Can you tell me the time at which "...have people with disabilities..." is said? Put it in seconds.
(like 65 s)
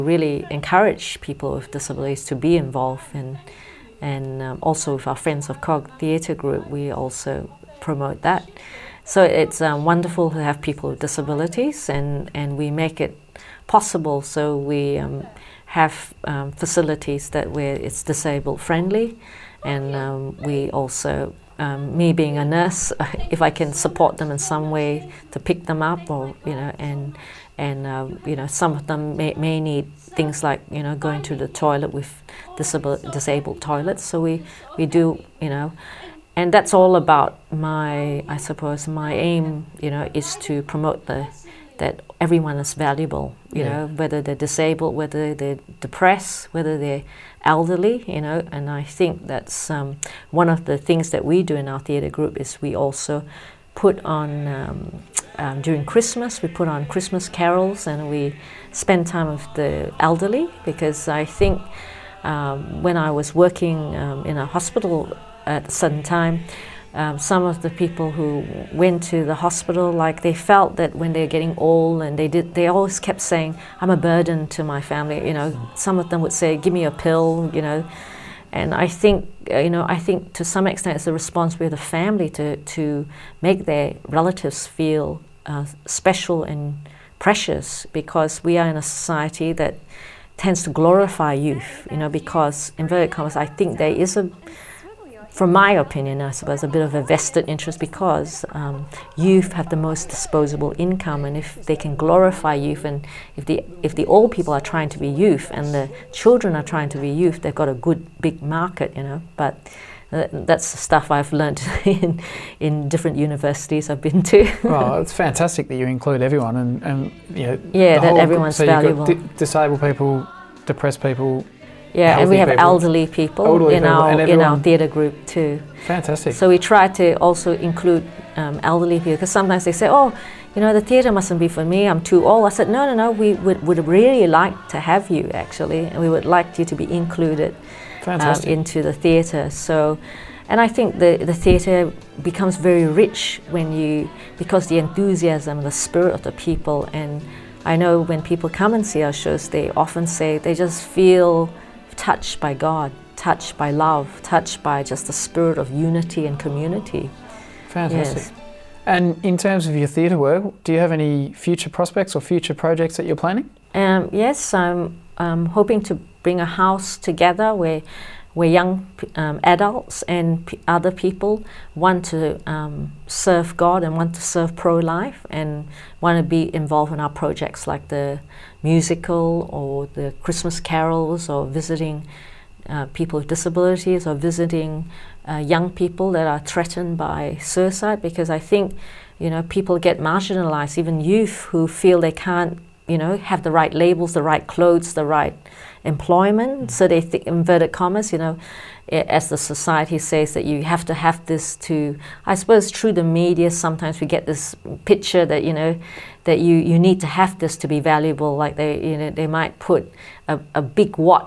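10 s.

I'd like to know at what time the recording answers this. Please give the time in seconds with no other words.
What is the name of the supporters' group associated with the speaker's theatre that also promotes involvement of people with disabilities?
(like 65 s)
5 s.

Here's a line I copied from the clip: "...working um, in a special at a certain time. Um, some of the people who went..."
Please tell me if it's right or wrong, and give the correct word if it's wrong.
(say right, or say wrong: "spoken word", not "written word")
wrong: "hospital", not "special".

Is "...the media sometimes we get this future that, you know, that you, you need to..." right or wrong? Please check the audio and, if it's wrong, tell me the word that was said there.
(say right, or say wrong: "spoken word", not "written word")
wrong: "picture", not "future".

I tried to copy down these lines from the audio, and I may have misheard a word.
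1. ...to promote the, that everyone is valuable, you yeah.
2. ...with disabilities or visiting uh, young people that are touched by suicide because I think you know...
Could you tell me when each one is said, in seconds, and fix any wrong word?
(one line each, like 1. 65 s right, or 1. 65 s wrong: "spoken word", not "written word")
1. 40 s right
2. 183 s wrong: "threatened", not "touched".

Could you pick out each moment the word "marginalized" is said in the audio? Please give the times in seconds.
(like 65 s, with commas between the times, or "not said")
189 s.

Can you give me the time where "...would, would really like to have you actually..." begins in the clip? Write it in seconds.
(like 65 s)
133 s.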